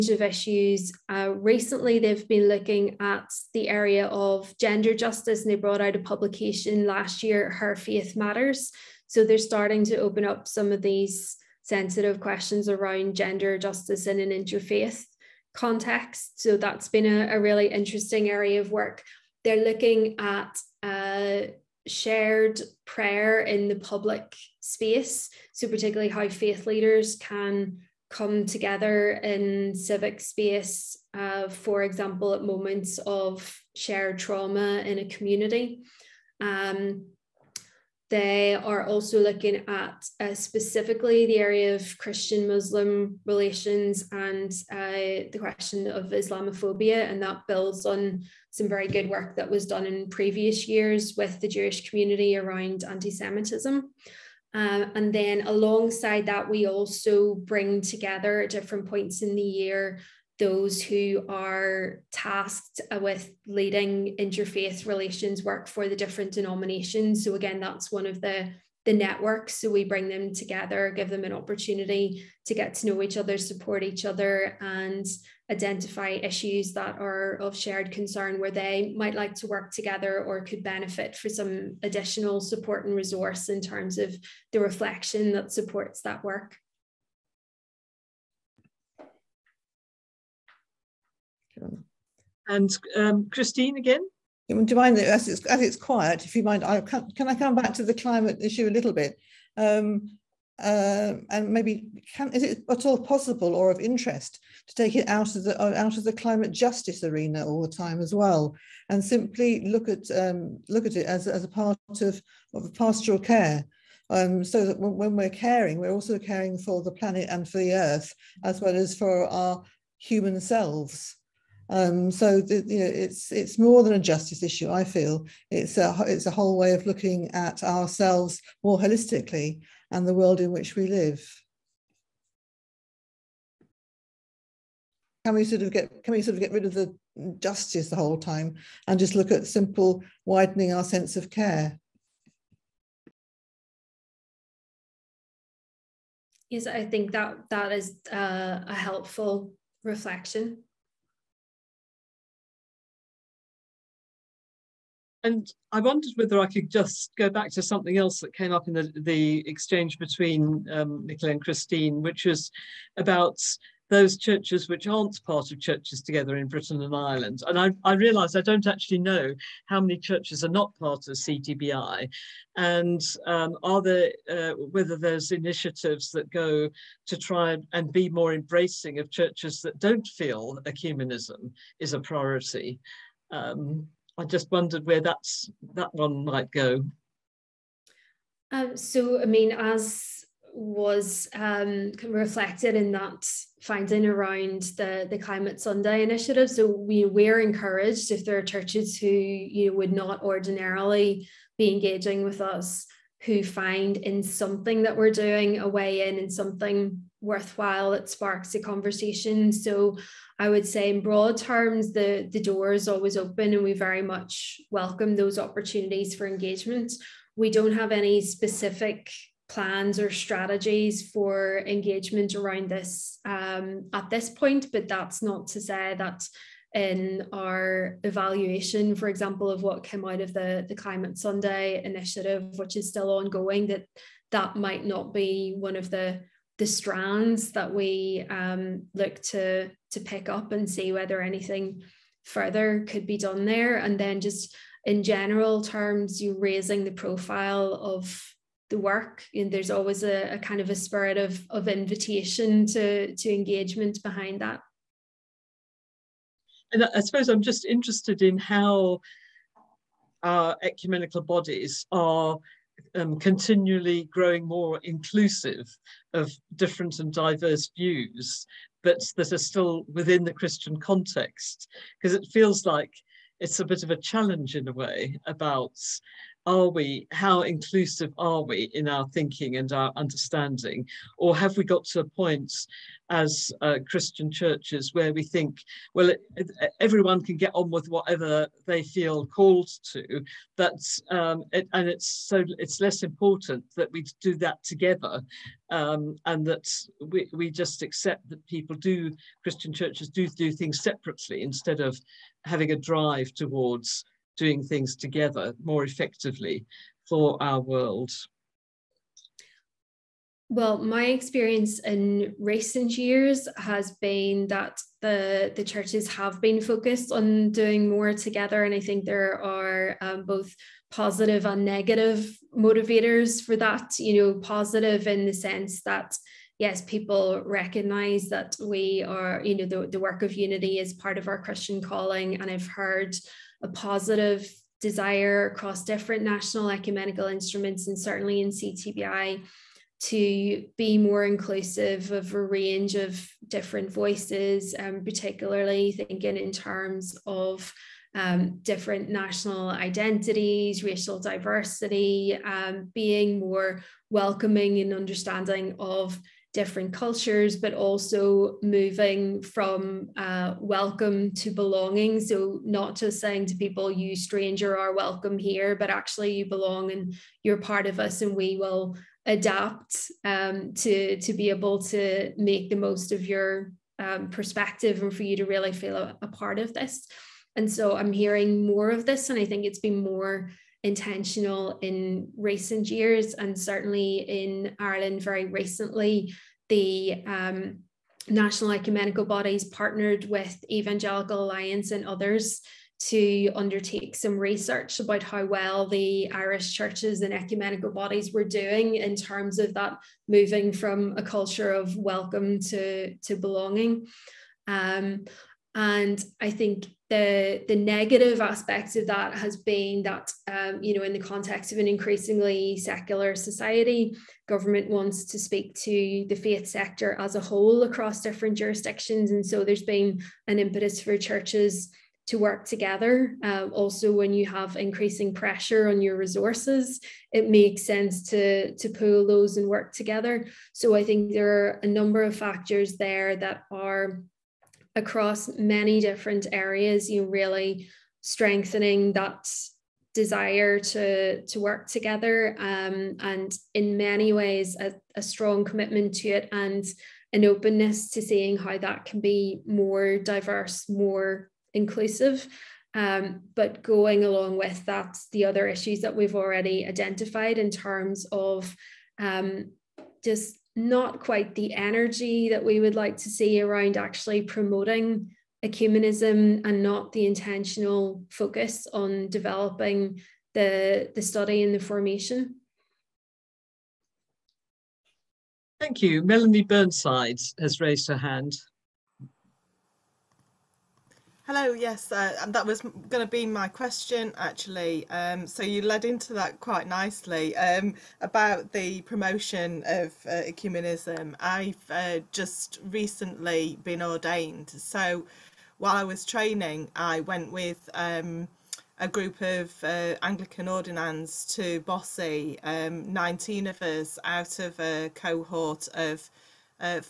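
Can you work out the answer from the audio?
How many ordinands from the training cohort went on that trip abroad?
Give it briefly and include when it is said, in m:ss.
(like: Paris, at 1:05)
19, at 8:23.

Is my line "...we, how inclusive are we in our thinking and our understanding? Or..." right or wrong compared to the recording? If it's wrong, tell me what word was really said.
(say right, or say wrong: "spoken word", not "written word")
right.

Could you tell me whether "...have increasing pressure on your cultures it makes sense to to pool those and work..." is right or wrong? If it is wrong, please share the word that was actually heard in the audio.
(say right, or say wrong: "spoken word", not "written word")
wrong: "resources", not "cultures".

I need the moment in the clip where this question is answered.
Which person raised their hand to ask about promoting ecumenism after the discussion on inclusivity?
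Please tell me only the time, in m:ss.
7:56.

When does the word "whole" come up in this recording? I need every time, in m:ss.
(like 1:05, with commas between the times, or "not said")
2:06, 2:17, 6:57.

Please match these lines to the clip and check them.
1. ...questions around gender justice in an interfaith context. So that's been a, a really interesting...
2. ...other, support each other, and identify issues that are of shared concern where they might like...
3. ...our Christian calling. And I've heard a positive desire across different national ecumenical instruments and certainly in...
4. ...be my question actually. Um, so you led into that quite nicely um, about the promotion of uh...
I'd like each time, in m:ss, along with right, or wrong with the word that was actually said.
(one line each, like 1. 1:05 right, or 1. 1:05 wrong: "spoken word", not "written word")
1. 0:12 right
2. 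1:13 right
3. 5:31 right
4. 8:03 right.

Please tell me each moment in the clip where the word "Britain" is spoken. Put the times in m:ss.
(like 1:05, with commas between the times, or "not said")
2:46.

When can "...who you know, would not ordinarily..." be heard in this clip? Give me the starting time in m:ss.
3:18.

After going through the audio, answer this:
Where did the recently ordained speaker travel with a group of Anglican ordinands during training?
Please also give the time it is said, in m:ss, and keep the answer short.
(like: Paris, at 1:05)
Bossey, at 8:21.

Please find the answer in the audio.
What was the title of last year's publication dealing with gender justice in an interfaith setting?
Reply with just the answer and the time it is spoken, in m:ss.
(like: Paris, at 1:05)
Her Faith Matters, at 0:07.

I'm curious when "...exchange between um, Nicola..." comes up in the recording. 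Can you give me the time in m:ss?
2:39.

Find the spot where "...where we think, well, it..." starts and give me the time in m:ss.
4:44.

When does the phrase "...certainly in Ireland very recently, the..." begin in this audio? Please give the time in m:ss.
6:23.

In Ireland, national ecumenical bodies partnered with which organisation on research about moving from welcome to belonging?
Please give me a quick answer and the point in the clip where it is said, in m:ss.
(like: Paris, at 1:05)
Evangelical Alliance, at 6:30.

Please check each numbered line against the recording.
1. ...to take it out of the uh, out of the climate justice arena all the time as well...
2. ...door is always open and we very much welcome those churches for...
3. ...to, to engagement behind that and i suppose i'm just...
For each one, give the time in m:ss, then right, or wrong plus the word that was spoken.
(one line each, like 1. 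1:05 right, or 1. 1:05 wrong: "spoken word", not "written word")
1. 1:44 right
2. 3:32 wrong: "opportunities", not "churches"
3. 4:12 right.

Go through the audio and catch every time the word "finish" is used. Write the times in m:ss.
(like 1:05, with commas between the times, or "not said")
not said.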